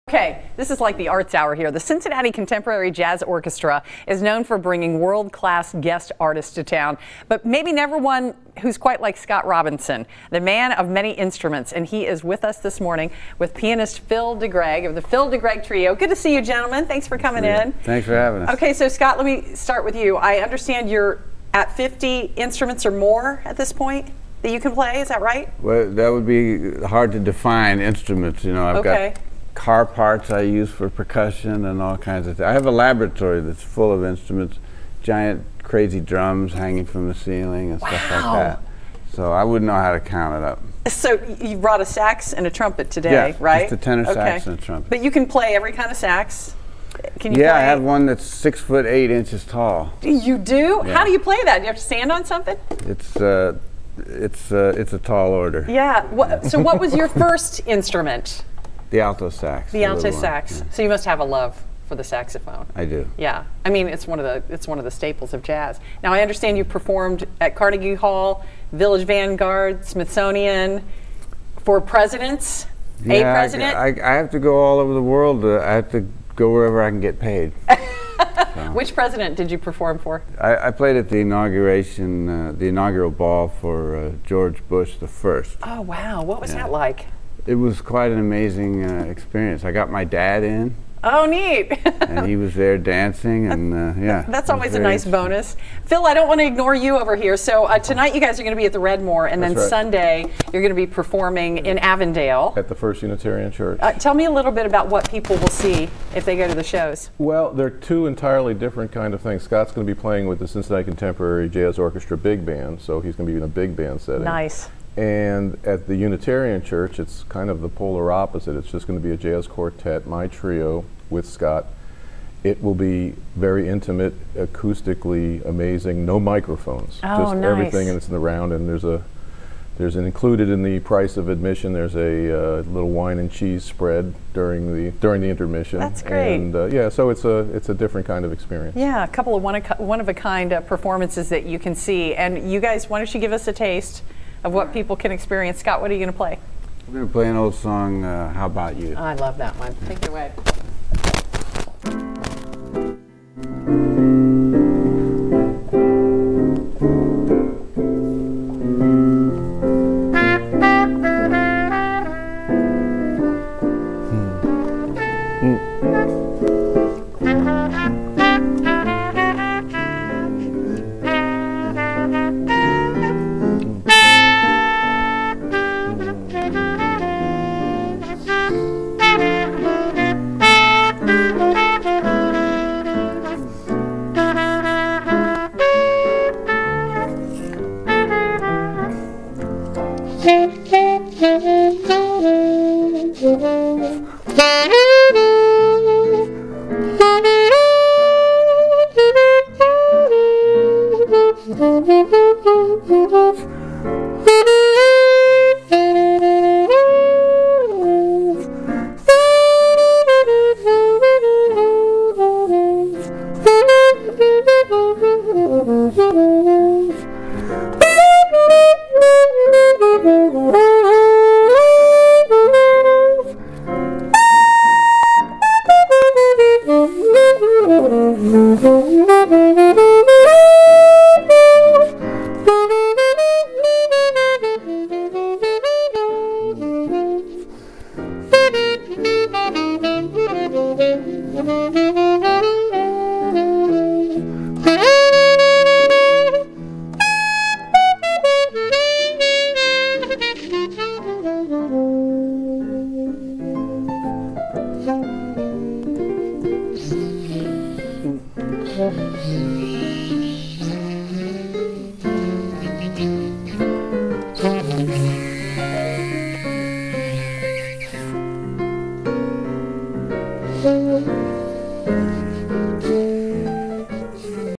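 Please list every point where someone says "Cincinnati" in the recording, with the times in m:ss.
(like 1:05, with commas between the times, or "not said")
0:01, 1:50.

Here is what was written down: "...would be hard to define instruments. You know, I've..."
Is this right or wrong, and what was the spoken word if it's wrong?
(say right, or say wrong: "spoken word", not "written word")
right.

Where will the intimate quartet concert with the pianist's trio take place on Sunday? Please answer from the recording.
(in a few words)
First Unitarian Church.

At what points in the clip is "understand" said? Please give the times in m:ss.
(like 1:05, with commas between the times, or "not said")
0:20, 1:06.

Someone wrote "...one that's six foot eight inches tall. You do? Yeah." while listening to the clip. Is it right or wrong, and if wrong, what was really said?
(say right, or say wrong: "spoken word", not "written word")
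right.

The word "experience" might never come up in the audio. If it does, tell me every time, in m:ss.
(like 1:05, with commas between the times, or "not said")
1:29, 2:18, 2:25.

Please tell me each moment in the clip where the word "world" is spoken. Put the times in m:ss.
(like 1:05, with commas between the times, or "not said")
0:04, 1:15.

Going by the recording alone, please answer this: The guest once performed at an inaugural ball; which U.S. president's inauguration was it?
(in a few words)
George Bush the first.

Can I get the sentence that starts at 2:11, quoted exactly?
There's a uh, little wine and cheese spread during the during the intermission.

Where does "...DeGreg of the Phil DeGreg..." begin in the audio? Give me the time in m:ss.
0:14.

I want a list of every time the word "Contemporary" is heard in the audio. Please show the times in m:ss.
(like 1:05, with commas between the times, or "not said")
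0:02, 1:50.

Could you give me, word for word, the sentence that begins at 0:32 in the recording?
I have a laboratory that's full of instruments, giant crazy drums hanging from the ceiling and wow.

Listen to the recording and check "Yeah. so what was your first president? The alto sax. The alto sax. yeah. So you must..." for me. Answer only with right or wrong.
wrong.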